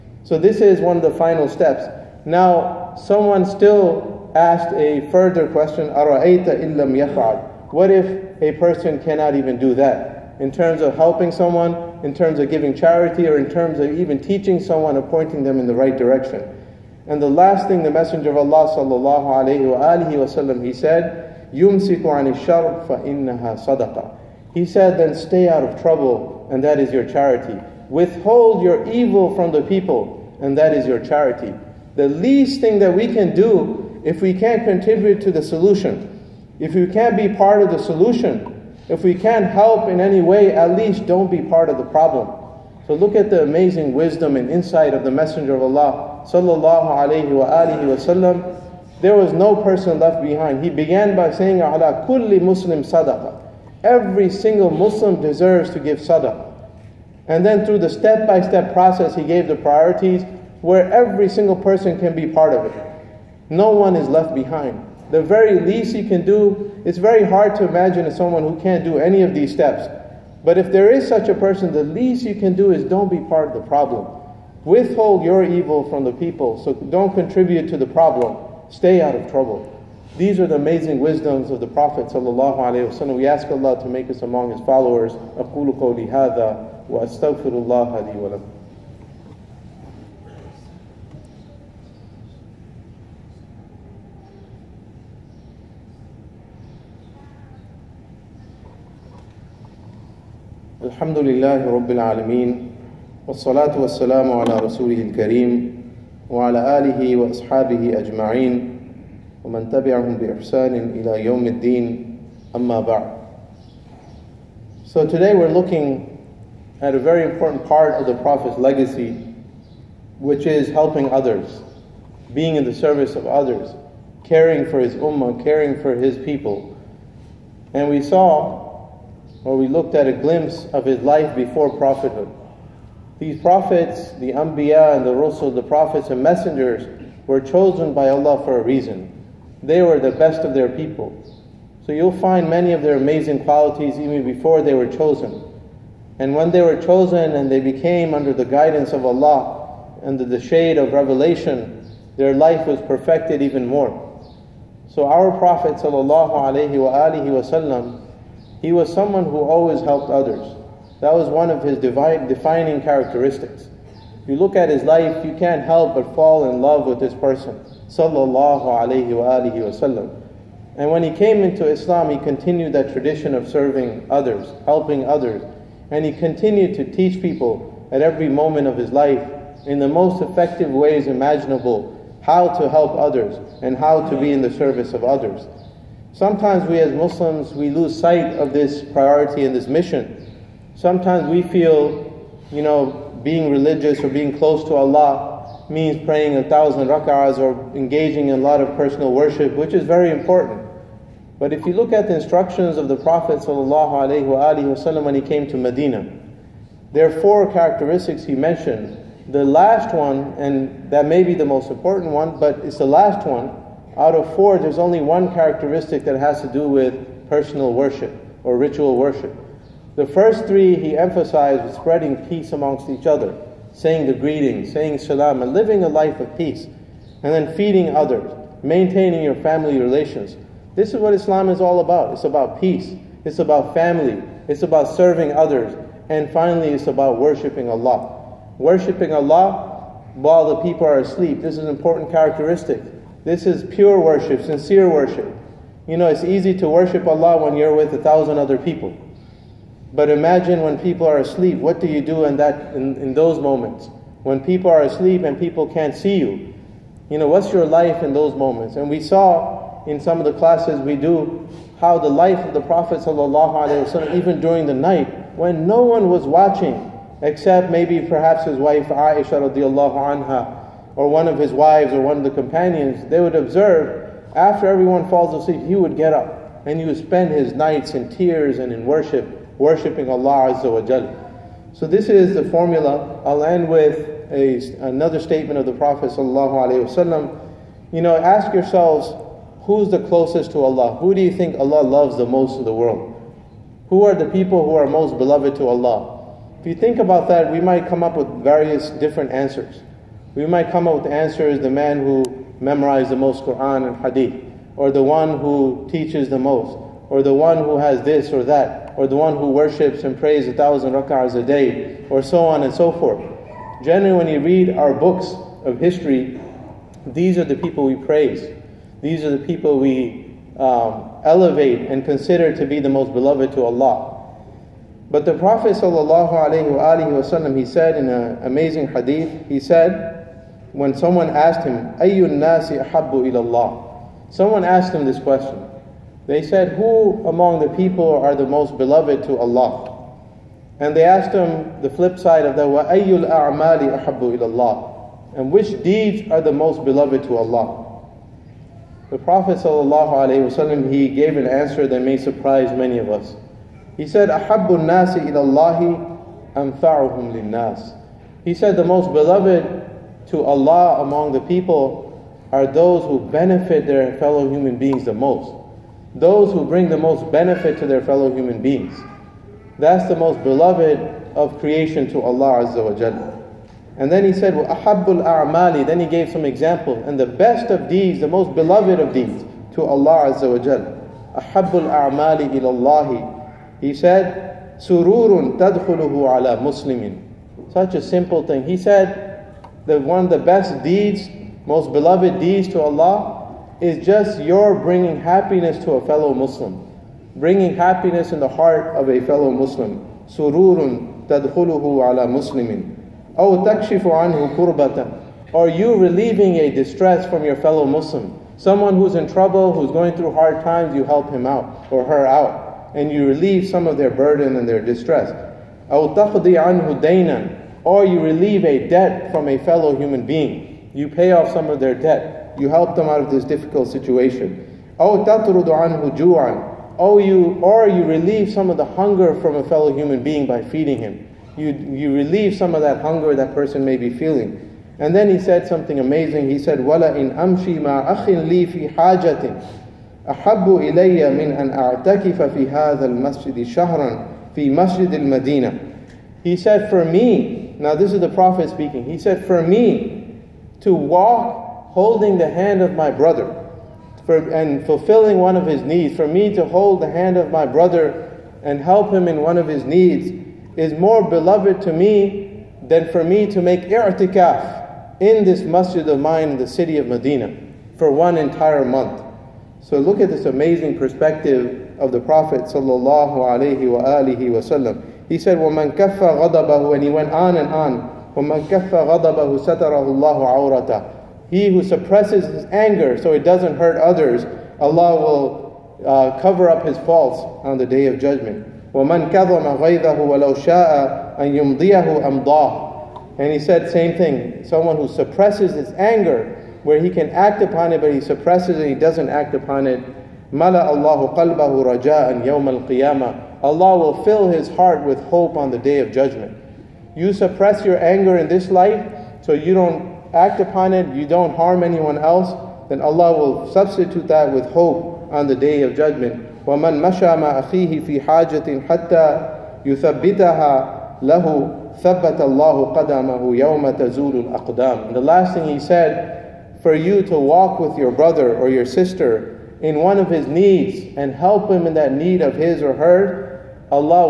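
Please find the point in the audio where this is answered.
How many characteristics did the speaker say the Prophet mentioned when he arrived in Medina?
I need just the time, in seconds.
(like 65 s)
207 s.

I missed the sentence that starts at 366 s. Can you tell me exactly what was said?
Those who bring the most benefit to their fellow human beings.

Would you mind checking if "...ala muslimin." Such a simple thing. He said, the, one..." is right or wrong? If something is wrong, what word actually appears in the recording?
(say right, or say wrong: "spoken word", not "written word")
right.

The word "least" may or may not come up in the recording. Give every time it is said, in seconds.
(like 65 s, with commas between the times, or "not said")
32 s, 40 s, 65 s, 71 s.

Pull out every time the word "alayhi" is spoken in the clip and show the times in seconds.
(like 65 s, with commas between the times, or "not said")
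19 s, 168 s.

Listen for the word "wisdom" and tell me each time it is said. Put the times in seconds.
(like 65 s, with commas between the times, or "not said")
43 s, 81 s.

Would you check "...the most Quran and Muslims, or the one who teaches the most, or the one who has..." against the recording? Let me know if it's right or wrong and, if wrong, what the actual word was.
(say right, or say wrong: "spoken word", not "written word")
wrong: "Hadith", not "Muslims".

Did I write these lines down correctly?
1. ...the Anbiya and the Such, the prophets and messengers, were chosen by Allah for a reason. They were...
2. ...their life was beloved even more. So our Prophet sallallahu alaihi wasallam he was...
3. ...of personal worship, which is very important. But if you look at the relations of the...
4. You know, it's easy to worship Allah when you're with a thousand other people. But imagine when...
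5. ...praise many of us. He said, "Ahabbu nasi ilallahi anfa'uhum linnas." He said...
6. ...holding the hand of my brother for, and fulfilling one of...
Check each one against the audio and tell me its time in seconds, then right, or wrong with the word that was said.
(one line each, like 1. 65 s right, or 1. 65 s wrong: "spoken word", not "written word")
1. 134 s wrong: "Rusul", not "Such"
2. 152 s wrong: "perfected", not "beloved"
3. 198 s wrong: "instructions", not "relations"
4. 245 s right
5. 352 s wrong: "surprise", not "praise"
6. 451 s right.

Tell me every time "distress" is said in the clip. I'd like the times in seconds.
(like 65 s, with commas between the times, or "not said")
406 s, 414 s.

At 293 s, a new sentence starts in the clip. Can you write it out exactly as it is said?
Who are the people who are most beloved to Allah?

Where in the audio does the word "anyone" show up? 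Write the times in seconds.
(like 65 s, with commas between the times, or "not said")
511 s.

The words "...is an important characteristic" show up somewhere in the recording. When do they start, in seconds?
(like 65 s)
241 s.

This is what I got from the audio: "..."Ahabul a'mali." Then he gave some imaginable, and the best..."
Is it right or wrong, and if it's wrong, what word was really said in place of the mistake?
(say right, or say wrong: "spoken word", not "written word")
wrong: "example", not "imaginable".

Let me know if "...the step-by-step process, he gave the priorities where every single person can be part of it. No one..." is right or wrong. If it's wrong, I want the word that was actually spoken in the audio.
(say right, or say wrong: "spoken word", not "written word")
right.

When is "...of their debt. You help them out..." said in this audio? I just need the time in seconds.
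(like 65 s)
421 s.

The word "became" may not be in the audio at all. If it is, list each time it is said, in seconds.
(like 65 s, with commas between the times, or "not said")
147 s.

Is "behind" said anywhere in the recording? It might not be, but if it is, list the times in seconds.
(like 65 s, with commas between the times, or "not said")
50 s, 64 s.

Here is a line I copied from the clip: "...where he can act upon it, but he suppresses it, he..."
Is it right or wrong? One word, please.
right.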